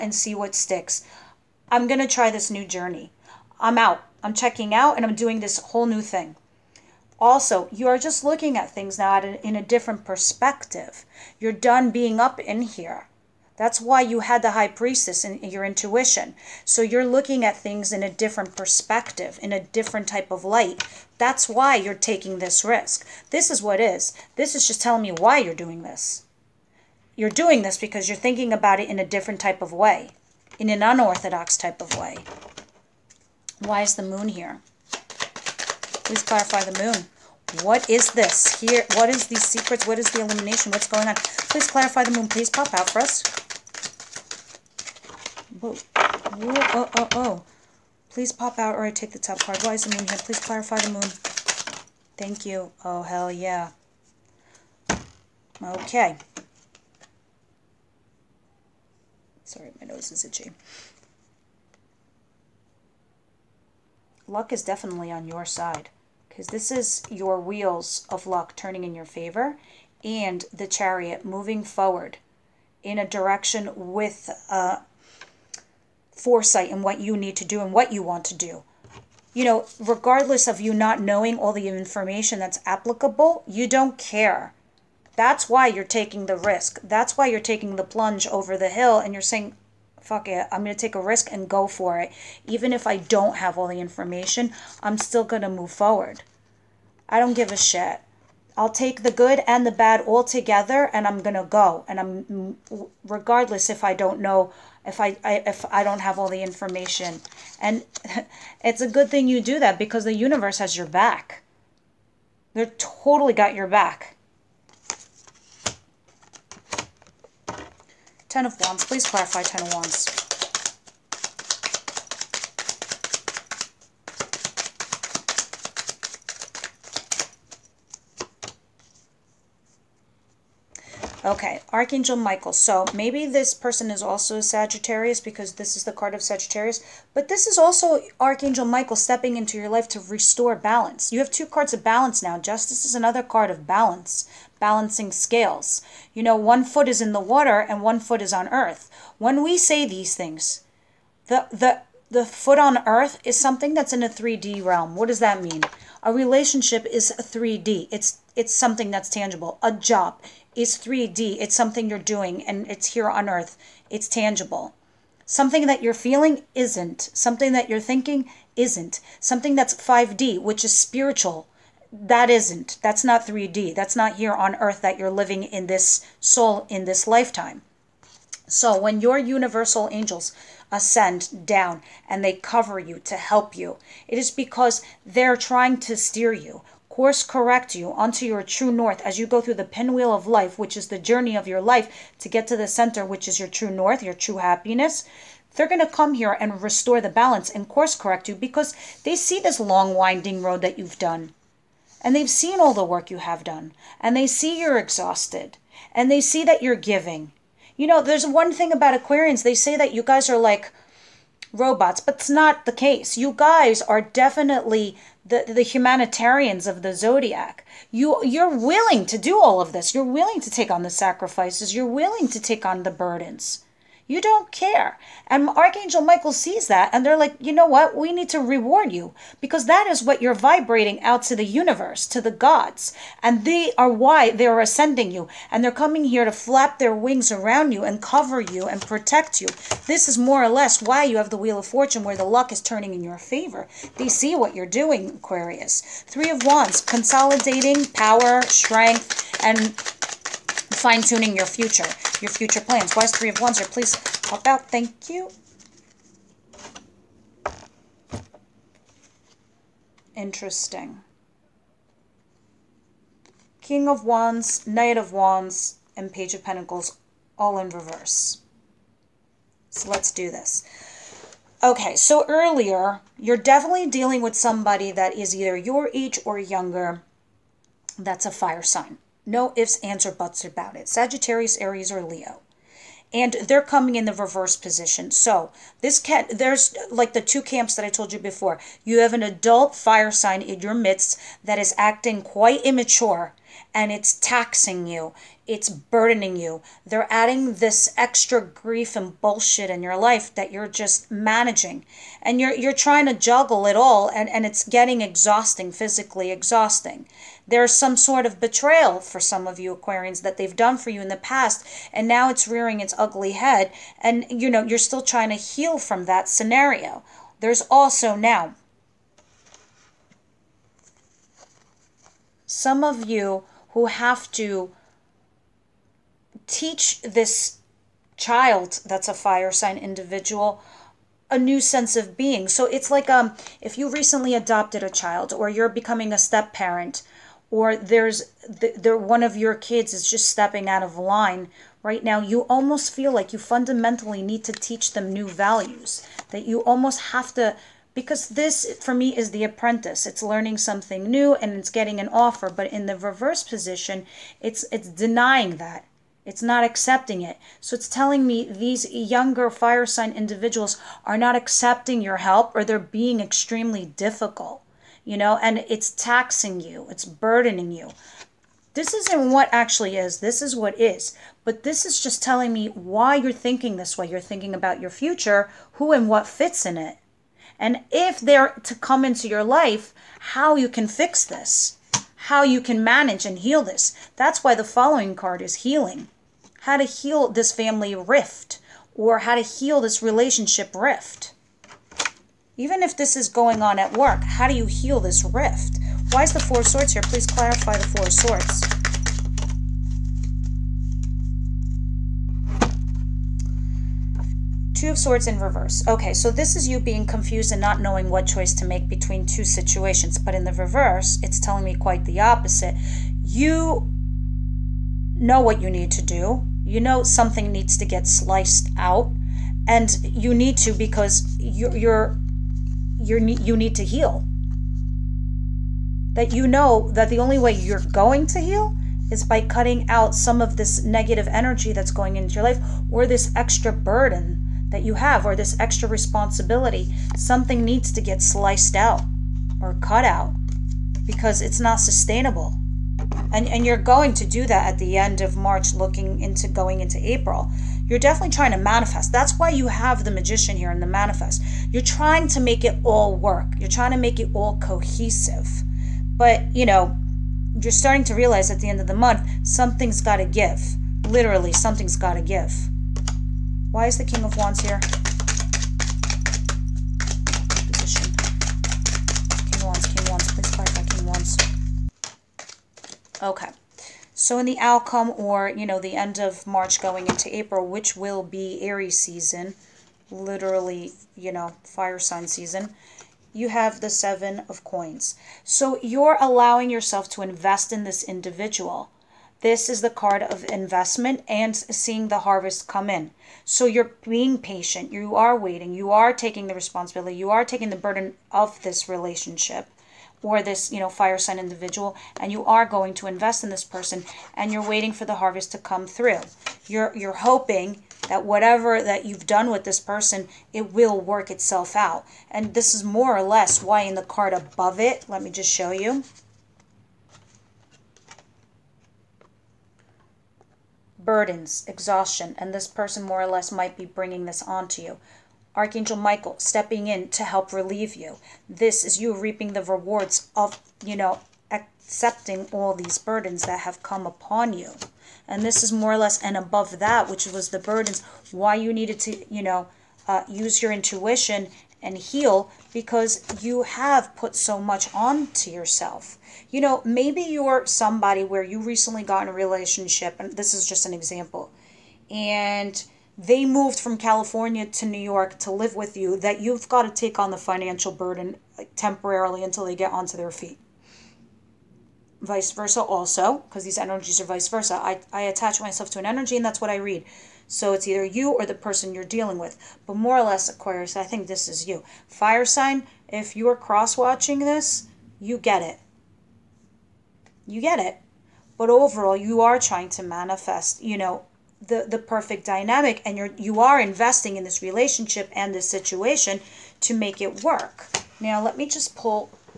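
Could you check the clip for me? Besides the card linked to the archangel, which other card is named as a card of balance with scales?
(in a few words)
Justice.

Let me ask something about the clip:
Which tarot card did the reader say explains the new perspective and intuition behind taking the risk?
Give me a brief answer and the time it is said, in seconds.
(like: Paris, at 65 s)
The High Priestess, at 14 s.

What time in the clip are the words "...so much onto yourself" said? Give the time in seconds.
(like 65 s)
544 s.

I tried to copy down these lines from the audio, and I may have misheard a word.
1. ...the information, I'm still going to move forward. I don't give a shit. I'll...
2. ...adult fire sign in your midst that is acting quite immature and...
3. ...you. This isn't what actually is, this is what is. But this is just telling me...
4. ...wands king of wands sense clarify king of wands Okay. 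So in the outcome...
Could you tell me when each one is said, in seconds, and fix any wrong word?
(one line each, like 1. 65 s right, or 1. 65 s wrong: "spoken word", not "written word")
1. 93 s right
2. 289 s right
3. 367 s right
4. 469 s wrong: "please", not "sense".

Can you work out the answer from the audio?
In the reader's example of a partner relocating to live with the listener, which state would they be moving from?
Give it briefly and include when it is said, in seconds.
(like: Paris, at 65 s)
California, at 553 s.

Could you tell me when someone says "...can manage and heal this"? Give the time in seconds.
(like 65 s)
382 s.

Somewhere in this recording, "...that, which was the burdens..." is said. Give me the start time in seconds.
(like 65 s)
536 s.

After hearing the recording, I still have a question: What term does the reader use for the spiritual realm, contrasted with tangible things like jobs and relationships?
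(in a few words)
5D.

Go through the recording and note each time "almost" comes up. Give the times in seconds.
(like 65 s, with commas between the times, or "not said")
342 s, 346 s.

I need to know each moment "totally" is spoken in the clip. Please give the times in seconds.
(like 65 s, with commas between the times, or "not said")
112 s.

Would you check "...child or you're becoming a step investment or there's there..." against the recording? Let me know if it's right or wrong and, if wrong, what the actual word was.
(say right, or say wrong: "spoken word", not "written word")
wrong: "parent", not "investment".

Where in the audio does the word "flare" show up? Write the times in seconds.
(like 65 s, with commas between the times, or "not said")
not said.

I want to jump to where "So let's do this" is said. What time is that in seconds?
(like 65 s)
269 s.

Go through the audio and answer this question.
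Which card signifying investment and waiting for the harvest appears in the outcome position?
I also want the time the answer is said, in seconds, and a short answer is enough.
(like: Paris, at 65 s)
Seven of Coins, at 483 s.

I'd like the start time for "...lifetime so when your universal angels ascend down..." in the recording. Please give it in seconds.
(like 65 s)
177 s.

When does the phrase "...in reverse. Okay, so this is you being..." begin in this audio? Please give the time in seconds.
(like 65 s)
405 s.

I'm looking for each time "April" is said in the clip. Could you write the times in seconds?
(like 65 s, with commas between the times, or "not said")
447 s, 477 s.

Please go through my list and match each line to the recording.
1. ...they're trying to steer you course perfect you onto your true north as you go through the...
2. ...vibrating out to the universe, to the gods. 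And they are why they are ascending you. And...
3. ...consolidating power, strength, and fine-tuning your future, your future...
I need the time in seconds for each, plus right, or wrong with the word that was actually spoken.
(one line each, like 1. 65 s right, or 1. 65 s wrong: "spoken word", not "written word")
1. 185 s wrong: "correct", not "perfect"
2. 230 s right
3. 246 s right.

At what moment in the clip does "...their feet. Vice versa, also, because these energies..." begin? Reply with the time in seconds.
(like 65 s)
560 s.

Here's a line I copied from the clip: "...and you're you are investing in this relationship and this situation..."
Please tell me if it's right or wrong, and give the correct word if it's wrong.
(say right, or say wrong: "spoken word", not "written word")
right.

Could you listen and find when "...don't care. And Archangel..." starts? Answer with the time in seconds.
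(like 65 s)
224 s.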